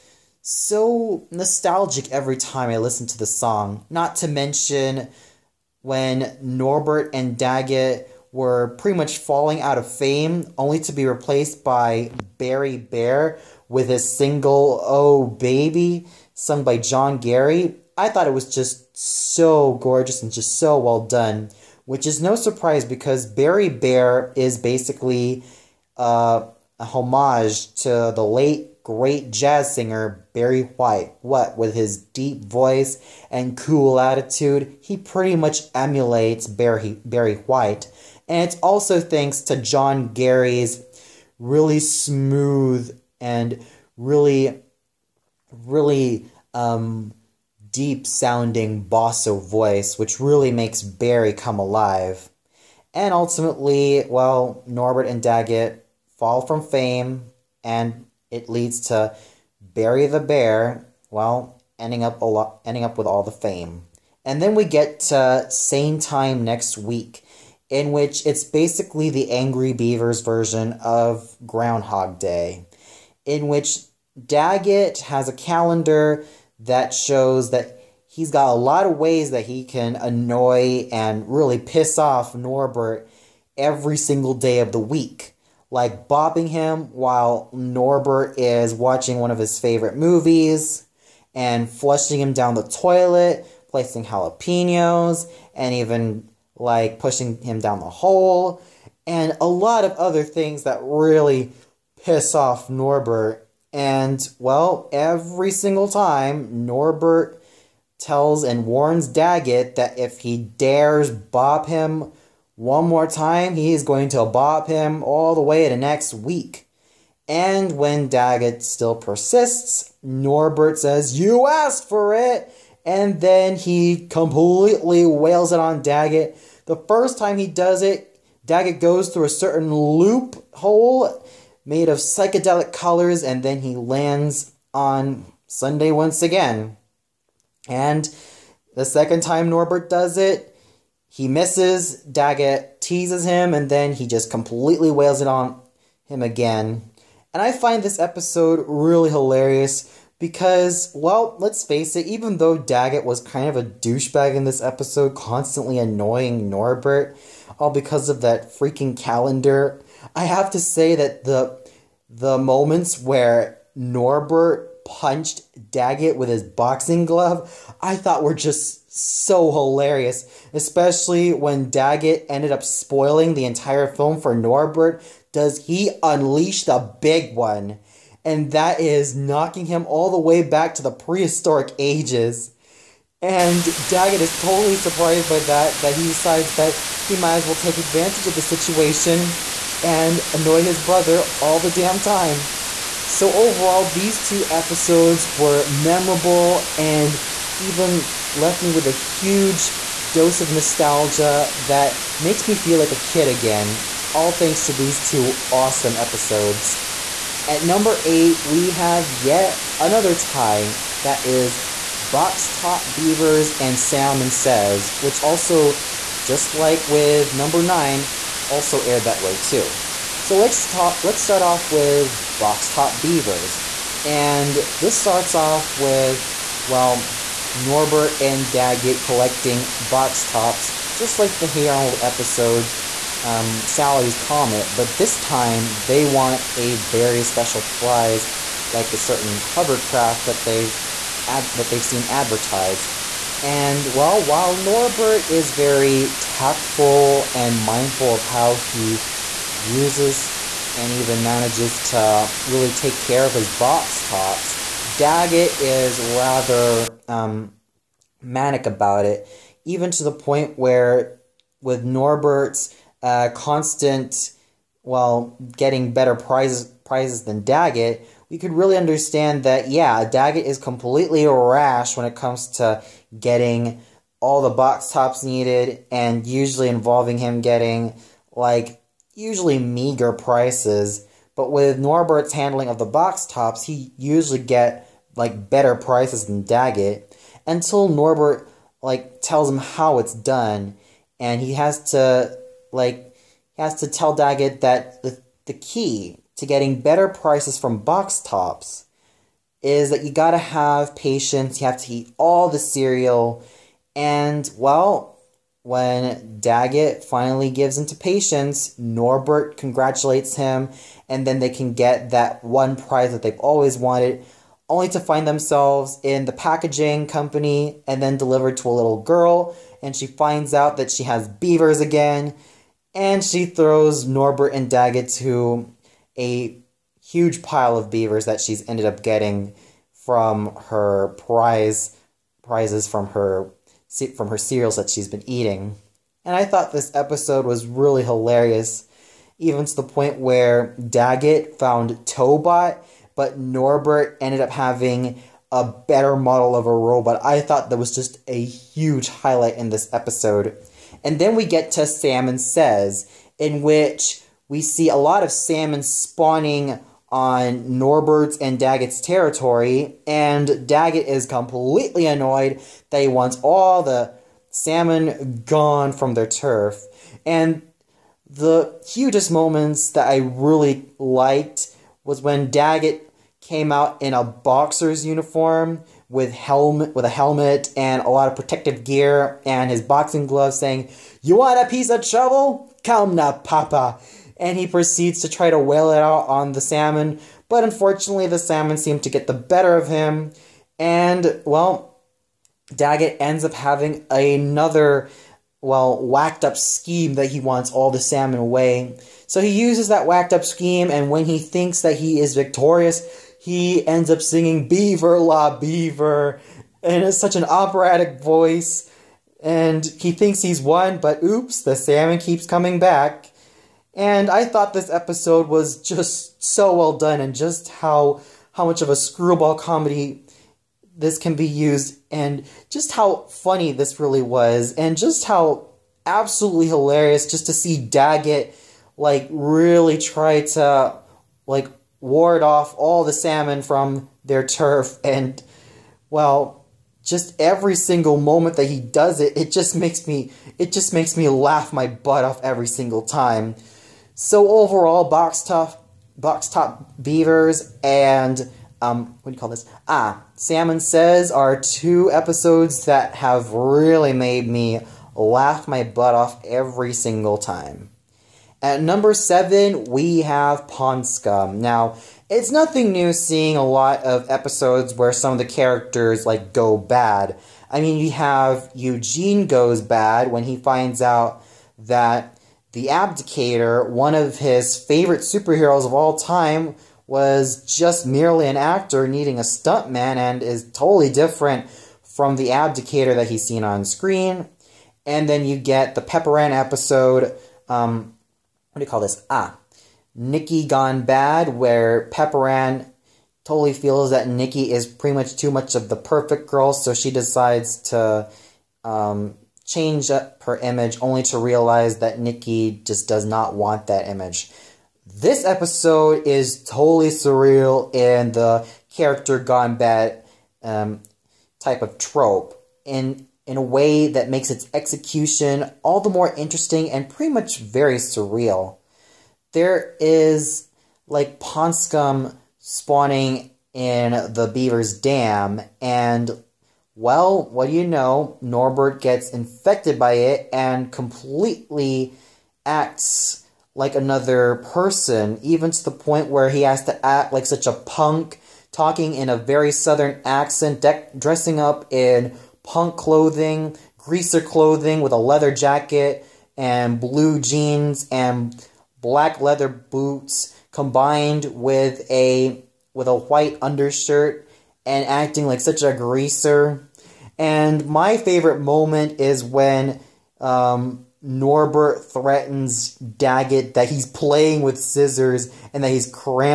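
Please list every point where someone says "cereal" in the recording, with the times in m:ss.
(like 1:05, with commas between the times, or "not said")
5:02, 5:34.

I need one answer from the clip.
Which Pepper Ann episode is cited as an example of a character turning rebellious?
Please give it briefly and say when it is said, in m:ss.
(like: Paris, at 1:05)
Nikki Gone Bad, at 8:10.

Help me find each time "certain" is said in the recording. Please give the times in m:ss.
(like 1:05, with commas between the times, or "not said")
2:09, 3:58.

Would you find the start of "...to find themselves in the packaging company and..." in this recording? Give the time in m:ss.
5:14.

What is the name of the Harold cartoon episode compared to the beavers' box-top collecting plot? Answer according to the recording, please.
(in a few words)
Sally's Comet.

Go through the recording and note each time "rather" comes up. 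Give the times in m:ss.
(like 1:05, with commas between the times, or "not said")
4:15.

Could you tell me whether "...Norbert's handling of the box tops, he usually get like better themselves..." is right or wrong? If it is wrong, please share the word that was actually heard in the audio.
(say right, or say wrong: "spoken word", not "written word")
wrong: "prices", not "themselves".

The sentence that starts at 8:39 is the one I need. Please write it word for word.
There is like pond scum spawning in the beaver's dam, and well, what do you know?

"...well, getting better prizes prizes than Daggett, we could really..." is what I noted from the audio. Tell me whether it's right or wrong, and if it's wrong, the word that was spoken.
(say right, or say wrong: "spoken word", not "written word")
right.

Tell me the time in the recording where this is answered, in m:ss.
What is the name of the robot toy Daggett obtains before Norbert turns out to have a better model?
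5:42.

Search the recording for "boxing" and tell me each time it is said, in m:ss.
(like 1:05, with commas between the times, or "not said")
2:46, 6:19.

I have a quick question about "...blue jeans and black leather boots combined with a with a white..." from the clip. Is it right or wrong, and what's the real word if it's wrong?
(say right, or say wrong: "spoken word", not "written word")
right.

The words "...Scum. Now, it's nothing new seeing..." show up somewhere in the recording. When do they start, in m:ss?
7:41.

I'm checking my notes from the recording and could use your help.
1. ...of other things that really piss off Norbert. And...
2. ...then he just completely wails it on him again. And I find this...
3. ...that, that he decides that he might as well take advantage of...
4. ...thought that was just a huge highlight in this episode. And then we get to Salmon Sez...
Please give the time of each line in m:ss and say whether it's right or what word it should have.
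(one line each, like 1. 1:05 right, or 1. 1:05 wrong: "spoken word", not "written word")
1. 1:39 right
2. 2:23 right
3. 3:05 right
4. 5:47 right.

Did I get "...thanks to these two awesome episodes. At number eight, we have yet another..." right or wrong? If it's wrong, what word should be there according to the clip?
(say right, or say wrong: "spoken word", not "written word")
right.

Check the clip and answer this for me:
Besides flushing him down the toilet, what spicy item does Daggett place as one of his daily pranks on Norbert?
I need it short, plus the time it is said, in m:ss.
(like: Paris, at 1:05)
Jalapenos, at 1:34.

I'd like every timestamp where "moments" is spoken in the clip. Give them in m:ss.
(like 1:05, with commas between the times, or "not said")
2:42, 6:09, 7:18, 9:18.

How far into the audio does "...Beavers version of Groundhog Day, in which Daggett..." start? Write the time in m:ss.
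1:09.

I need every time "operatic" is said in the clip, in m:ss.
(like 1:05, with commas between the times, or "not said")
6:47.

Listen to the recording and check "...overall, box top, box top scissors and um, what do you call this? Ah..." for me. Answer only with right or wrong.
wrong.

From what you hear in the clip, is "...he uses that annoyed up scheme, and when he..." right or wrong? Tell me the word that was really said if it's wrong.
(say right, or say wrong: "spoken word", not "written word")
wrong: "whacked", not "annoyed".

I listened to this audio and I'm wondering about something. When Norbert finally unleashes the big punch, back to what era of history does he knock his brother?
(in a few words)
Prehistoric ages.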